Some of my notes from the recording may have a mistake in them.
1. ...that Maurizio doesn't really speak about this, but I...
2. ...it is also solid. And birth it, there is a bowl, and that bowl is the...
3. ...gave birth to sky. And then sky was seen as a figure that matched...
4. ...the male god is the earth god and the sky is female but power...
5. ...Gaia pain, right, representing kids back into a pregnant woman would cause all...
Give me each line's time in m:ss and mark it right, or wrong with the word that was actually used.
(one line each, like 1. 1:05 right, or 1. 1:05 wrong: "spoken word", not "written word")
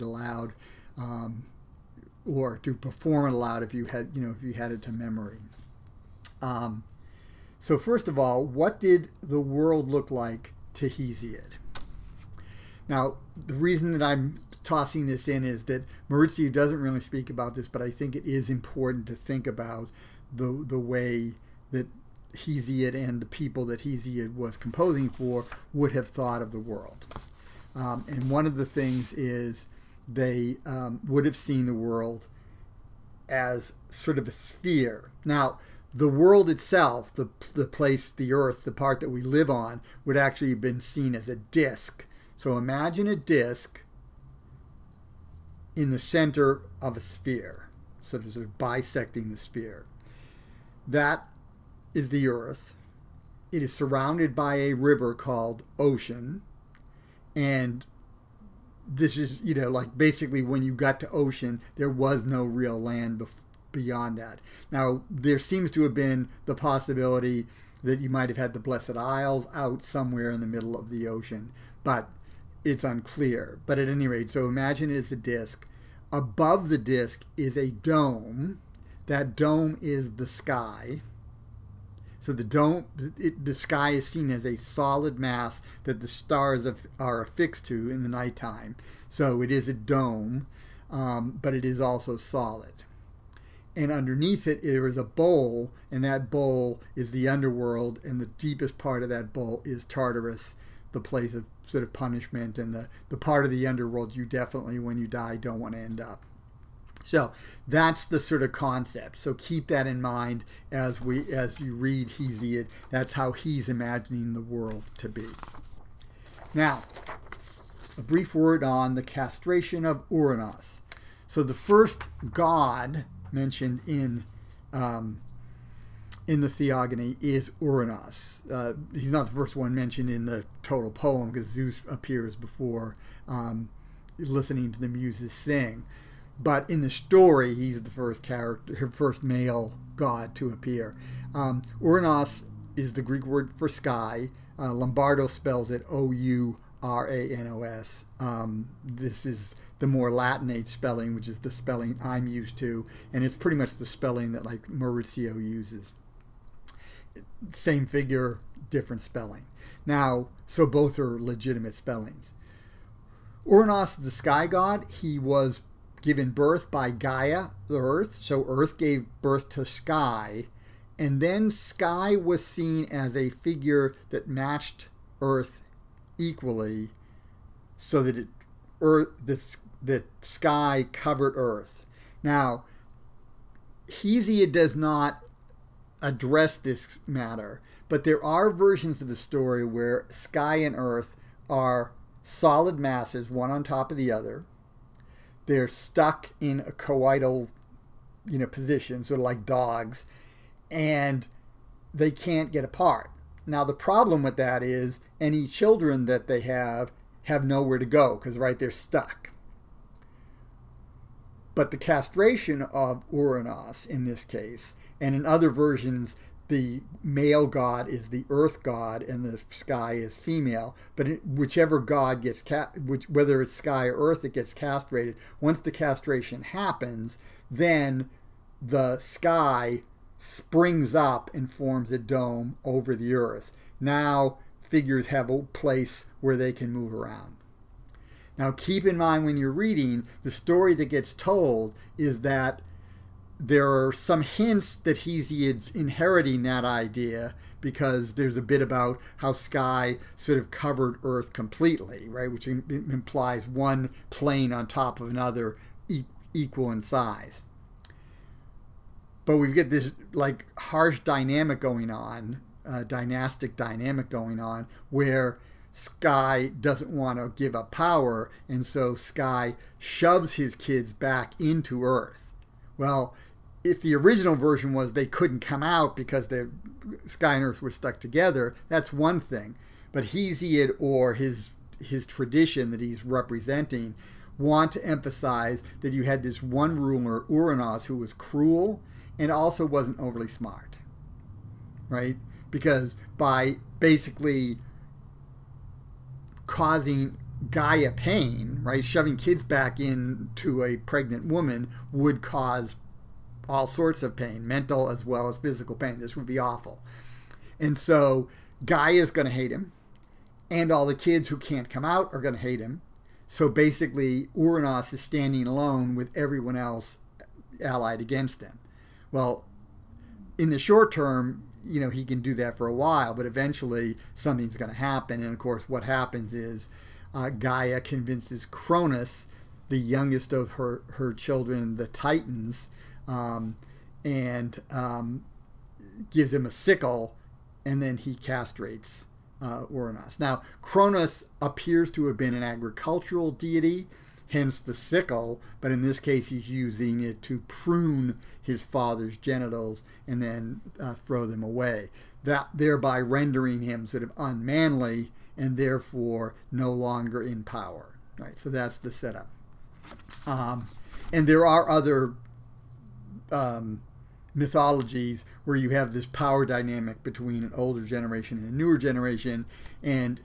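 1. 0:15 right
2. 1:31 wrong: "underneath", not "birth"
3. 2:48 right
4. 3:36 wrong: "whichever", not "power"
5. 4:57 wrong: "shoving", not "representing".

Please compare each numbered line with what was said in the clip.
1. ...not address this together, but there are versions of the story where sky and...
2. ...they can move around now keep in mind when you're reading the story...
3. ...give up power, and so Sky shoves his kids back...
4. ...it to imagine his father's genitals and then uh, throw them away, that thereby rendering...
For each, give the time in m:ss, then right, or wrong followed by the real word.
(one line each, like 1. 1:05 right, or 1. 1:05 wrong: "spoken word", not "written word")
1. 3:04 wrong: "matter", not "together"
2. 3:56 right
3. 4:27 right
4. 5:47 wrong: "prune", not "imagine".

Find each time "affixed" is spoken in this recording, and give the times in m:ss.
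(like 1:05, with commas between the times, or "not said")
1:27.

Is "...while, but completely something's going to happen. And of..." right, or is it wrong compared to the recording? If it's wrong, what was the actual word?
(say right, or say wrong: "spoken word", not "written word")
wrong: "eventually", not "completely".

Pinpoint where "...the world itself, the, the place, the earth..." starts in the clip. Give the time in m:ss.
0:35.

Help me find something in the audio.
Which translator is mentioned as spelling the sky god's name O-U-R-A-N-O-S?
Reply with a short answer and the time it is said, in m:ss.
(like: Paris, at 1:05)
Lombardo, at 2:24.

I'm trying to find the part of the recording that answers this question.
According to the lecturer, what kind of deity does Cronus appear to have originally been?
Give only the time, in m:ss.
5:42.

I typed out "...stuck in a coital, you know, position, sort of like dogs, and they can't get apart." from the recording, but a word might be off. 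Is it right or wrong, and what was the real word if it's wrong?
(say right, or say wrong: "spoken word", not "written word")
right.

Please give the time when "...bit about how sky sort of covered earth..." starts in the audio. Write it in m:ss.
4:08.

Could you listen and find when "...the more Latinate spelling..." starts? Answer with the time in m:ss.
2:29.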